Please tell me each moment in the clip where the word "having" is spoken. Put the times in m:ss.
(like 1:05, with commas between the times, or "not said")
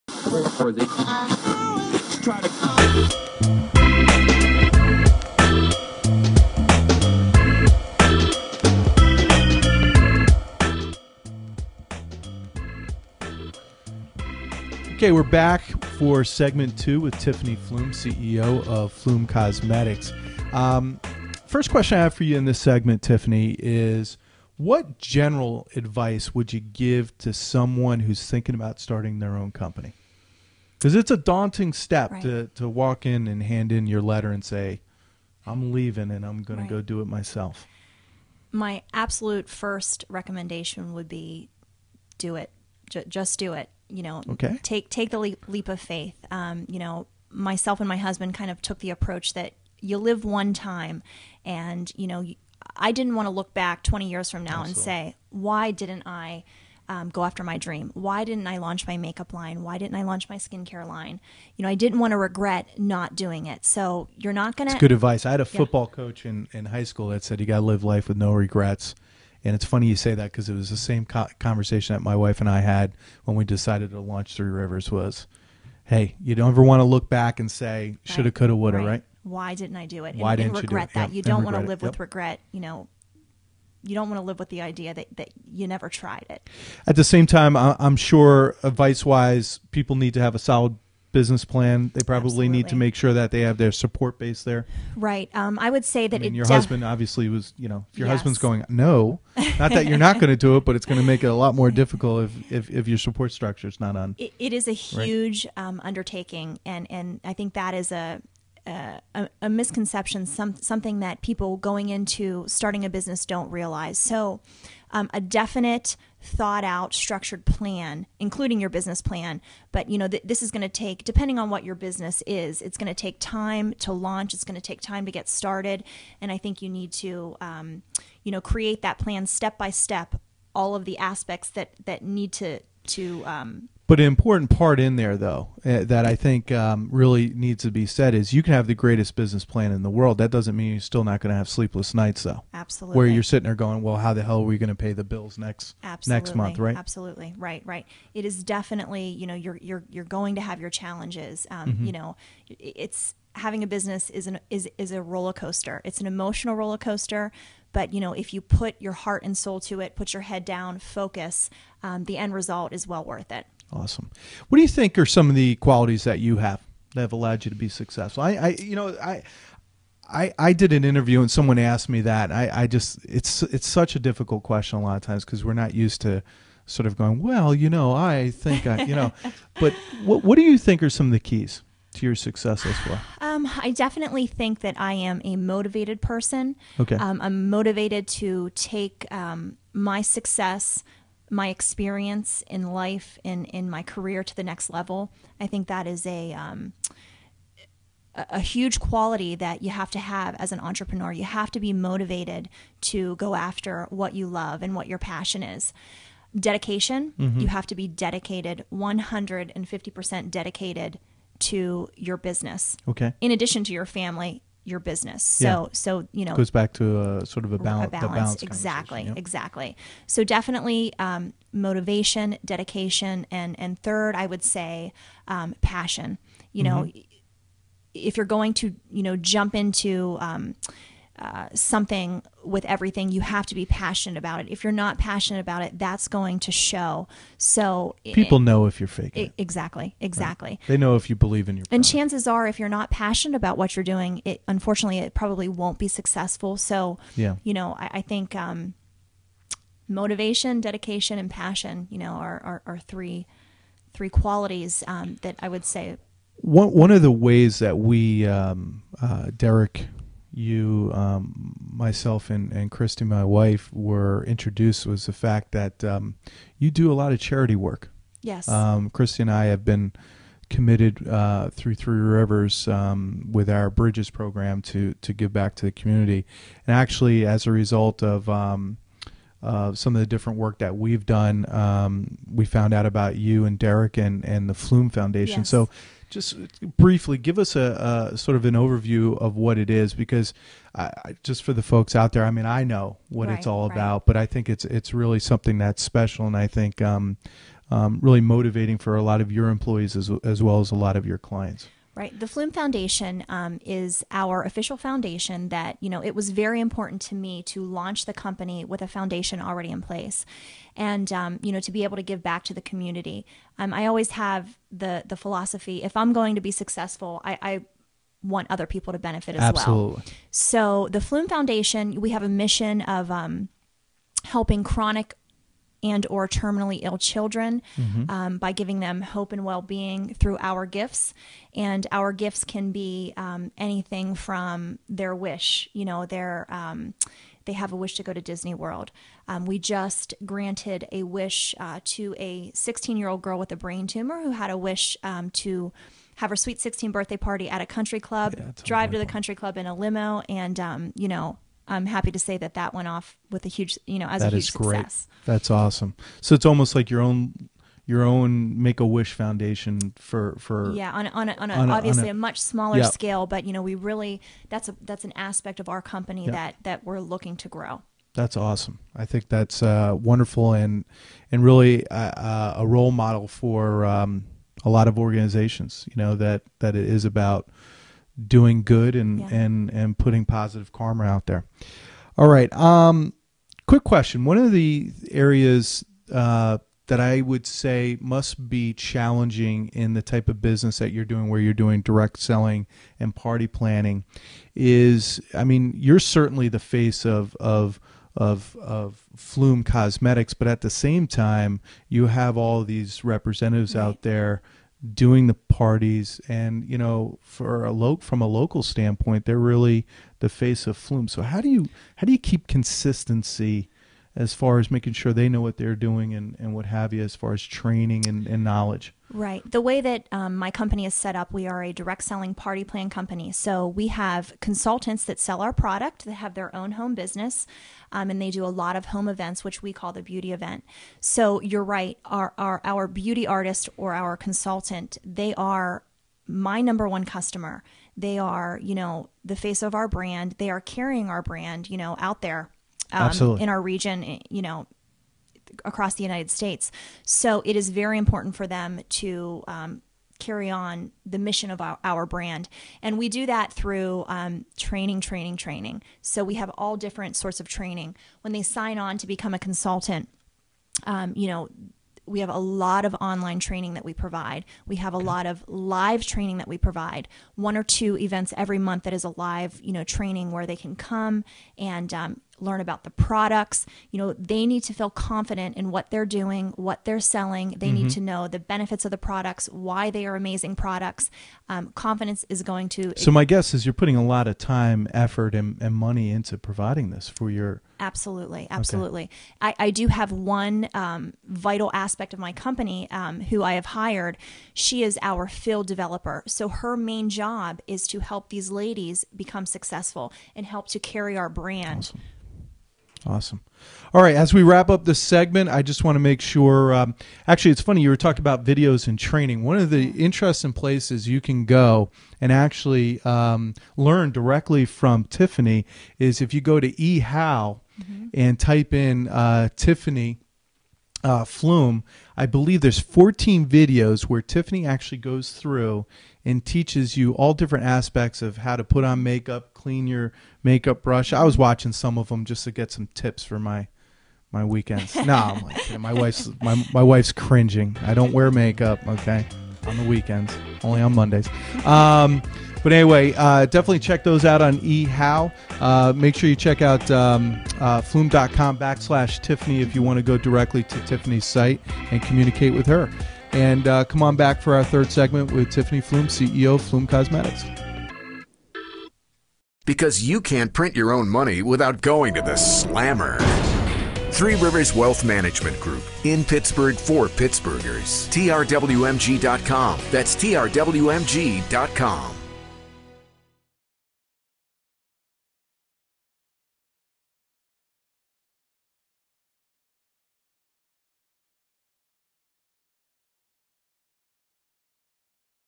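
2:33.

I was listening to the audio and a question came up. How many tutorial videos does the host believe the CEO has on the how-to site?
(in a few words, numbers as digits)
14.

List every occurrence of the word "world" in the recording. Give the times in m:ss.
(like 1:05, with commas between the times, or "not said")
2:19, 5:38.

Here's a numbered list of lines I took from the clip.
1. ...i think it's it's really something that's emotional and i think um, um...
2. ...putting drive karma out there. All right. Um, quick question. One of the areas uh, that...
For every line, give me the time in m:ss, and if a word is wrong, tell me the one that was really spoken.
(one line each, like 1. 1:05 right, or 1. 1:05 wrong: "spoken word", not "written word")
1. 4:54 wrong: "special", not "emotional"
2. 6:19 wrong: "positive", not "drive".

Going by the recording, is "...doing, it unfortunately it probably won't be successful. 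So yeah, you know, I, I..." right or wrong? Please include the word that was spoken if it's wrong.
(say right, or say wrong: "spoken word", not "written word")
right.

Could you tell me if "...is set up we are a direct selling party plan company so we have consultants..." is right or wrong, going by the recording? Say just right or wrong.
right.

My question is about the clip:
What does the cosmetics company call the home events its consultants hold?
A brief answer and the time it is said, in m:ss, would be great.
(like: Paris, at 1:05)
the beauty event, at 7:10.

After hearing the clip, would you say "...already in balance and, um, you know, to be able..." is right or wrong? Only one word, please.
wrong.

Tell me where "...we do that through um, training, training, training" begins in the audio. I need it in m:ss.
7:32.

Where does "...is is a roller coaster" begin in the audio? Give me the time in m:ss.
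2:34.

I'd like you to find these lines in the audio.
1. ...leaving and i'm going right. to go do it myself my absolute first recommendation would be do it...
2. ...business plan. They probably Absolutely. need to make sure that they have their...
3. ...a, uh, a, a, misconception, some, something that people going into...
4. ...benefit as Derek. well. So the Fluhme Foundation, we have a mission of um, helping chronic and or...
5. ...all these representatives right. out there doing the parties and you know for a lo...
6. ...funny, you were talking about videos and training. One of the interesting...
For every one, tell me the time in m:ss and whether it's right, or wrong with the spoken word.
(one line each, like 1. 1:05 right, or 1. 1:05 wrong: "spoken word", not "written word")
1. 0:35 right
2. 1:31 right
3. 1:47 right
4. 5:18 wrong: "Absolutely", not "Derek"
5. 6:42 right
6. 8:27 right.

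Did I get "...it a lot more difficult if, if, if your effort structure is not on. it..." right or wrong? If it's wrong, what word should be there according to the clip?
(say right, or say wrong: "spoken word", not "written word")
wrong: "support", not "effort".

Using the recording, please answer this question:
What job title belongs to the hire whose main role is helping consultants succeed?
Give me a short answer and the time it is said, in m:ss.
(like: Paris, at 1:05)
field developer, at 8:15.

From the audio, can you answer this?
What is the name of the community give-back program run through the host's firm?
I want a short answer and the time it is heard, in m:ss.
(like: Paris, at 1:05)
Bridges, at 4:33.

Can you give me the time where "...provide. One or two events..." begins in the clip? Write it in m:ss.
7:46.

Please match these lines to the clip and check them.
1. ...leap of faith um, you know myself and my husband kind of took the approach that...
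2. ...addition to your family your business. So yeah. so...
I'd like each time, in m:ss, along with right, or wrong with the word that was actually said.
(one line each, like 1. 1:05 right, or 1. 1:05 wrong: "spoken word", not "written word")
1. 0:45 right
2. 3:33 right.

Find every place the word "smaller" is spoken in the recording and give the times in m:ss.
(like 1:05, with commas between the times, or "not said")
6:02.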